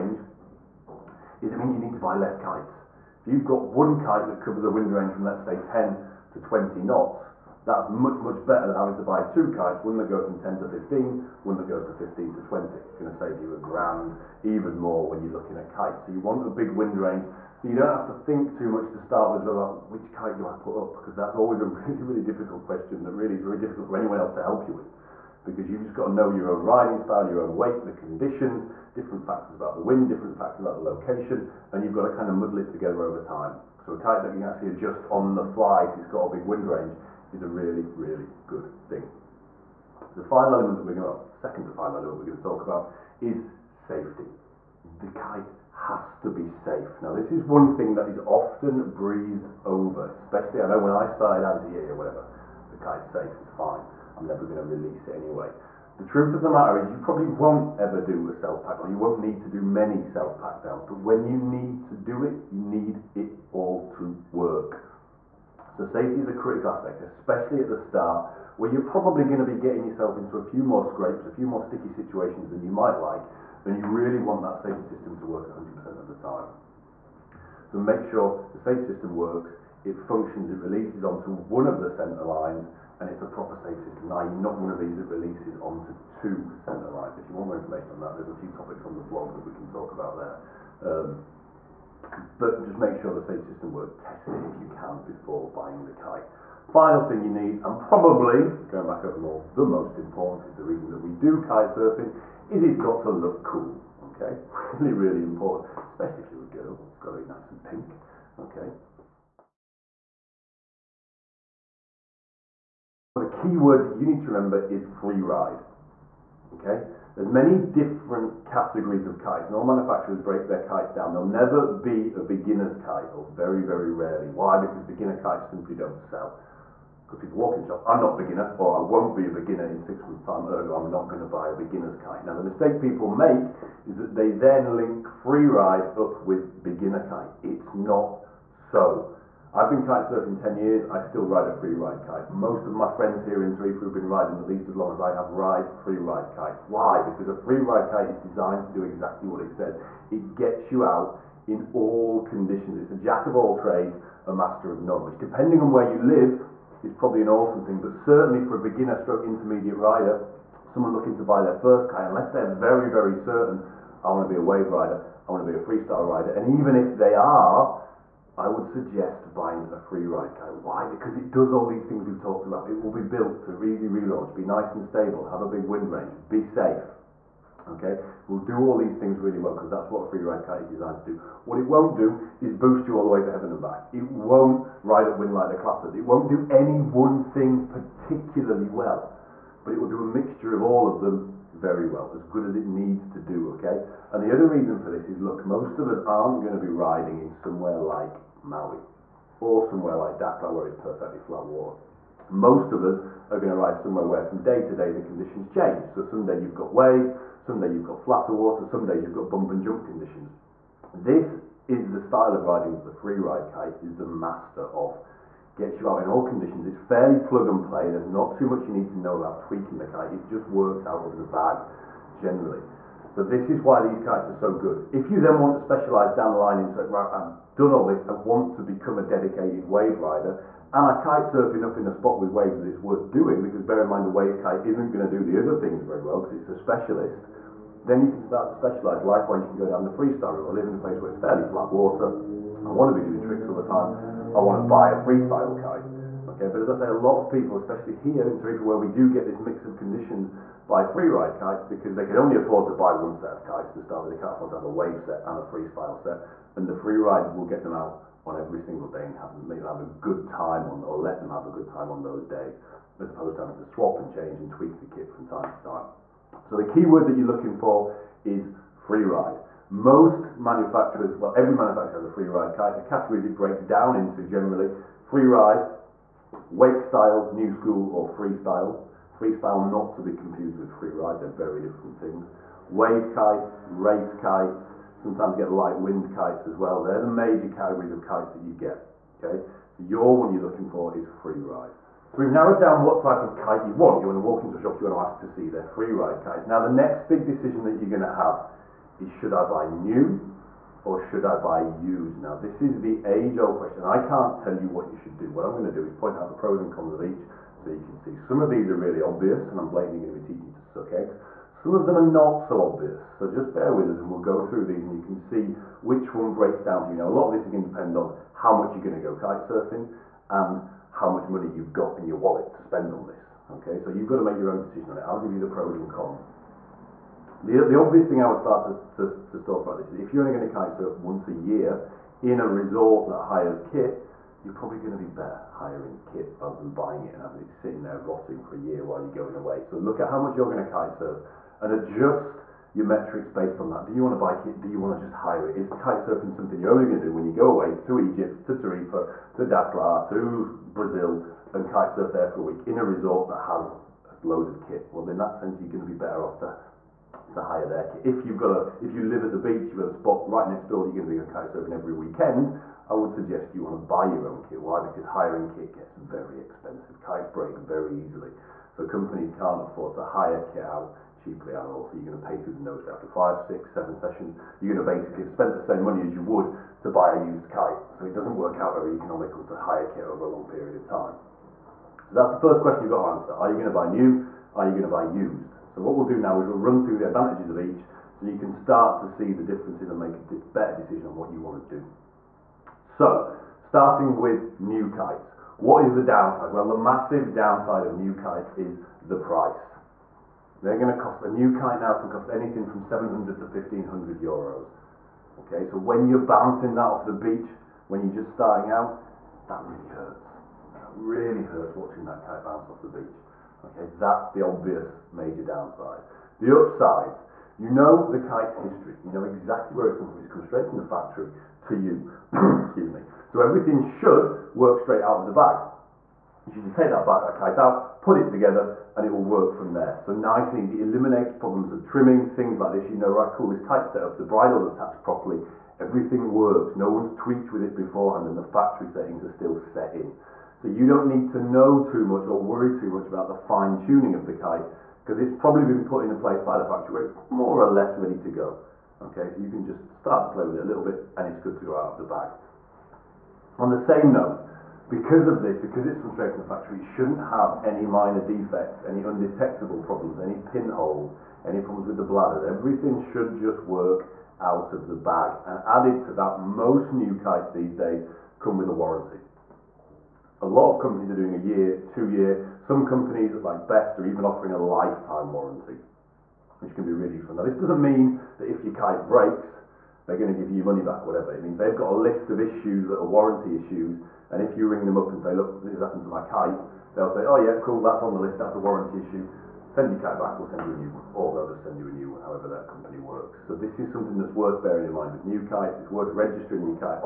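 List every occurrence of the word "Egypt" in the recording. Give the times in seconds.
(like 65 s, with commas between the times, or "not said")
347 s.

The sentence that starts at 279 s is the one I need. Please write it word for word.
Freestyle not to be confused with free ride, they're very different things.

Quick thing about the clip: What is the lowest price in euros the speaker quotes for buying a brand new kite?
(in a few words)
700 euros.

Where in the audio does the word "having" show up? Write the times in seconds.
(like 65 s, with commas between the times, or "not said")
8 s, 263 s, 337 s.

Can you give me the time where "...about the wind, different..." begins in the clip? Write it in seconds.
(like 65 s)
29 s.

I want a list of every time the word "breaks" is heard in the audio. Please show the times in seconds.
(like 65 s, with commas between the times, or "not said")
120 s, 273 s, 316 s, 367 s, 479 s.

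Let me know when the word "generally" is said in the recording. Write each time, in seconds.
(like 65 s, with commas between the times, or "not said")
222 s, 274 s.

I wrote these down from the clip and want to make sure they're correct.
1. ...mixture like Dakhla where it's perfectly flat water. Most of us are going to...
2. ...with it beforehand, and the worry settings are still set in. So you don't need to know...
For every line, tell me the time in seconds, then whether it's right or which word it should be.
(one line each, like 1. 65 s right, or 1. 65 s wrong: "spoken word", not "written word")
1. 199 s wrong: "somewhere", not "mixture"
2. 437 s wrong: "factory", not "worry".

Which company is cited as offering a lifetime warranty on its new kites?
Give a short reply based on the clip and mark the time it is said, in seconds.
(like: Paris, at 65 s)
Best, at 473 s.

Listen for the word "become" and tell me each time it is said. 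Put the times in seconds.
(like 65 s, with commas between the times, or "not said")
228 s.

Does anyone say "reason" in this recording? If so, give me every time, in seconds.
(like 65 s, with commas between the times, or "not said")
100 s, 194 s.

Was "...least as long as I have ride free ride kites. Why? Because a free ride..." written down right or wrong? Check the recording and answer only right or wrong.
right.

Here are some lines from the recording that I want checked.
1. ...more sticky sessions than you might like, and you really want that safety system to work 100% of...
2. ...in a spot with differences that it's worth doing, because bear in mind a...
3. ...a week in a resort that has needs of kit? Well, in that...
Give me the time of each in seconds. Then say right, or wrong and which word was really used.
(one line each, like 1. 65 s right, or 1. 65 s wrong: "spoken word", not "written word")
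1. 71 s wrong: "situations", not "sessions"
2. 231 s wrong: "waves", not "differences"
3. 352 s wrong: "loads", not "needs".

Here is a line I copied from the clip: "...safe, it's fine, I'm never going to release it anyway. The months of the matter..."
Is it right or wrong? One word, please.
wrong.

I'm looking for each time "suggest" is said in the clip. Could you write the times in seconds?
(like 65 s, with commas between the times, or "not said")
168 s, 363 s.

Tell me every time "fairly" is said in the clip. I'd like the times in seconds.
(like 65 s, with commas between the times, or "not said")
216 s, 241 s.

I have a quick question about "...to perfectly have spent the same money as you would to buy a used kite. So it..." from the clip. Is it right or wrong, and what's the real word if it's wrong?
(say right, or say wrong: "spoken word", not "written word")
wrong: "basically", not "perfectly".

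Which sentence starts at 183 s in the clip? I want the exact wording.
It won't ride wind like the clappers.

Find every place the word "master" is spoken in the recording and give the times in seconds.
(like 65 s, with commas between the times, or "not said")
154 s, 214 s.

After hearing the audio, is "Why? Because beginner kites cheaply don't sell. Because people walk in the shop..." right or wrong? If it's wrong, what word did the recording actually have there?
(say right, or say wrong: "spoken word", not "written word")
wrong: "simply", not "cheaply".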